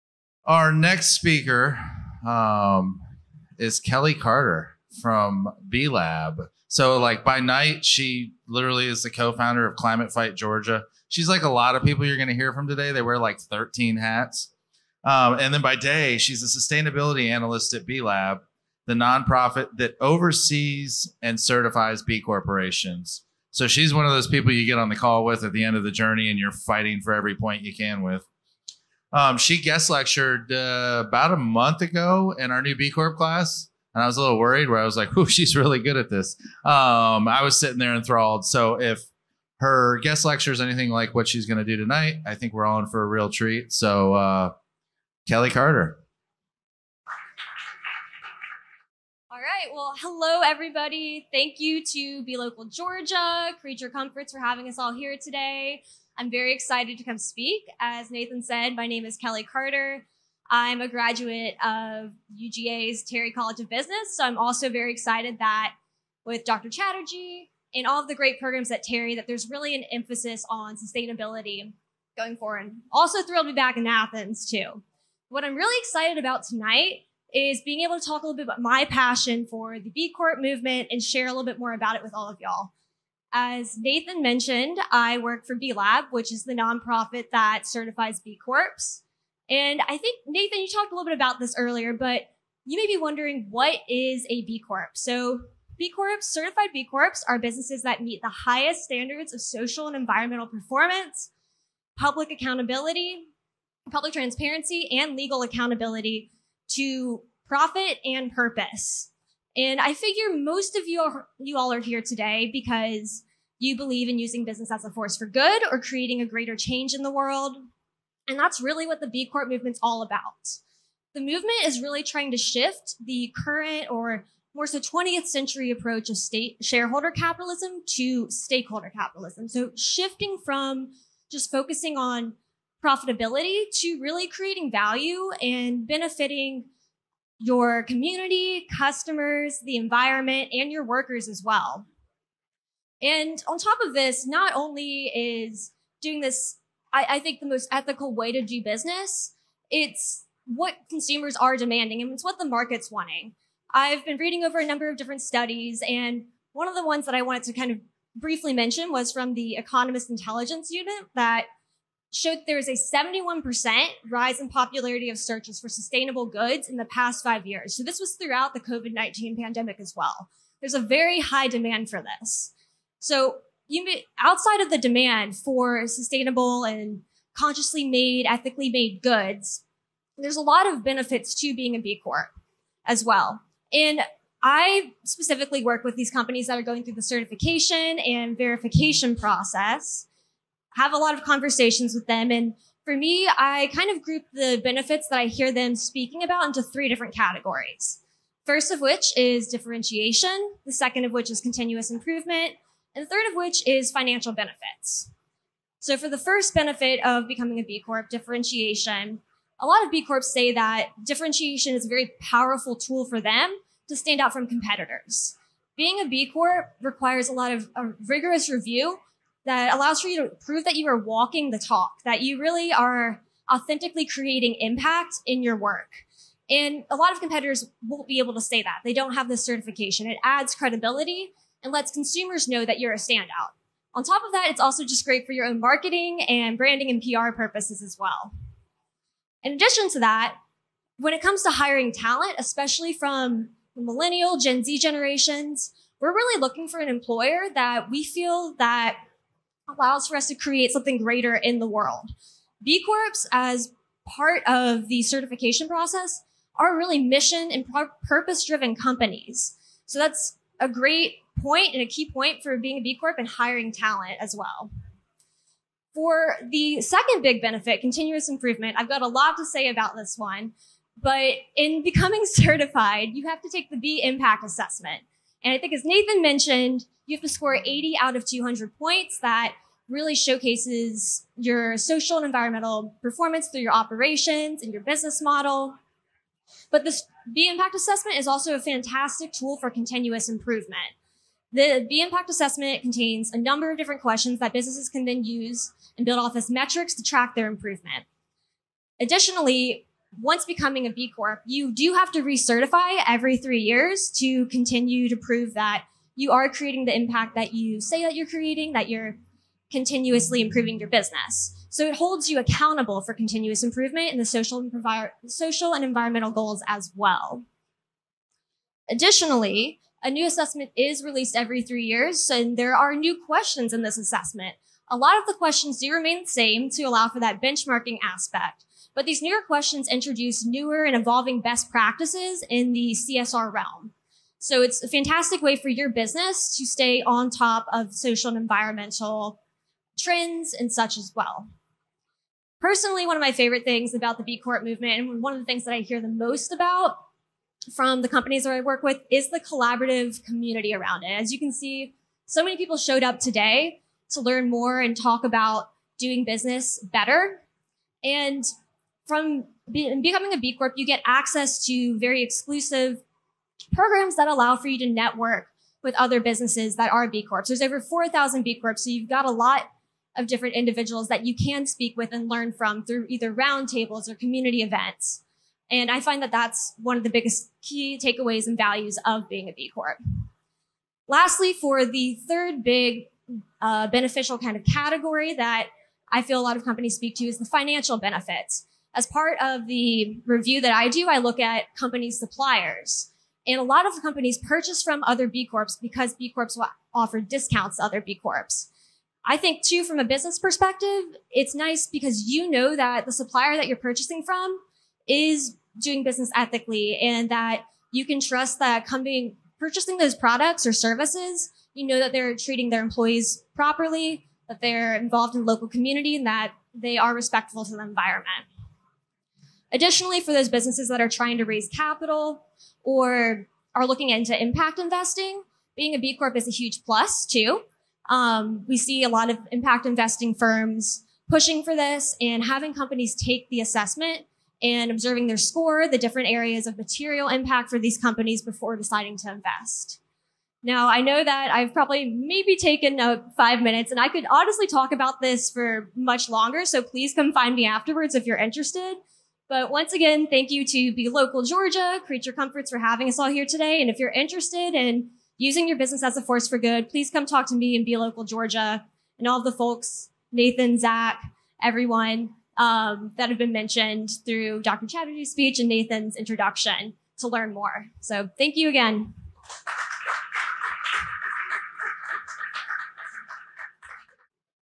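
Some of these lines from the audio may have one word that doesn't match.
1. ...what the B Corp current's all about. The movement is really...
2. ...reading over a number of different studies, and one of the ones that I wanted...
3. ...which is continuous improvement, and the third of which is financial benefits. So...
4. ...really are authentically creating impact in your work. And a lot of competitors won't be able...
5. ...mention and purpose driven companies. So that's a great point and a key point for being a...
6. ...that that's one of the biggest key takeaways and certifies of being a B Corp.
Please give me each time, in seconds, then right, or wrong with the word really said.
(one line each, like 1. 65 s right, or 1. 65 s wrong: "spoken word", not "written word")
1. 118 s wrong: "movement", not "current"
2. 154 s right
3. 201 s right
4. 222 s right
5. 256 s wrong: "mission", not "mention"
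6. 376 s wrong: "values", not "certifies".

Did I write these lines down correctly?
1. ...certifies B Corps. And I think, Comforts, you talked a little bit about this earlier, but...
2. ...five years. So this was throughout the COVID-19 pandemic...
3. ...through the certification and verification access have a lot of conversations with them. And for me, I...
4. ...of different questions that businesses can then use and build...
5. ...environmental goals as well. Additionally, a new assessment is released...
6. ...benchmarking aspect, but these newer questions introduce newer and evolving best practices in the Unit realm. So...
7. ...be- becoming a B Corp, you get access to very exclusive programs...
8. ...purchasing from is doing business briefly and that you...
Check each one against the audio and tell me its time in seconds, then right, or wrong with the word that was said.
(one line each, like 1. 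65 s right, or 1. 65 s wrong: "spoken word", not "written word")
1. 87 s wrong: "Nathan", not "Comforts"
2. 167 s right
3. 186 s wrong: "process", not "access"
4. 293 s right
5. 315 s right
6. 327 s wrong: "CSR", not "Unit"
7. 359 s right
8. 403 s wrong: "ethically", not "briefly".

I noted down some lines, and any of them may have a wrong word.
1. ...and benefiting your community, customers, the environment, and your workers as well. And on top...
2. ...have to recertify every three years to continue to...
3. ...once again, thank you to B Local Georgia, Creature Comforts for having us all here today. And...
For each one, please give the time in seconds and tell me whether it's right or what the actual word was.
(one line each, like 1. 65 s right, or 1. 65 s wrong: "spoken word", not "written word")
1. 135 s right
2. 301 s right
3. 449 s right.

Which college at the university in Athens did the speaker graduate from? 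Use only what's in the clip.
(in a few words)
Terry College of Business.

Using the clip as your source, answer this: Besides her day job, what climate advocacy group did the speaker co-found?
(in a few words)
Climate Fight Georgia.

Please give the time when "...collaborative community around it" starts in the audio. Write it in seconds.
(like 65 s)
349 s.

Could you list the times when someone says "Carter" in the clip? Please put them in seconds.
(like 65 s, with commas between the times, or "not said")
4 s, 45 s, 59 s.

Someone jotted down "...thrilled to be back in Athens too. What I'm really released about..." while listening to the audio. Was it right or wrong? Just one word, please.
wrong.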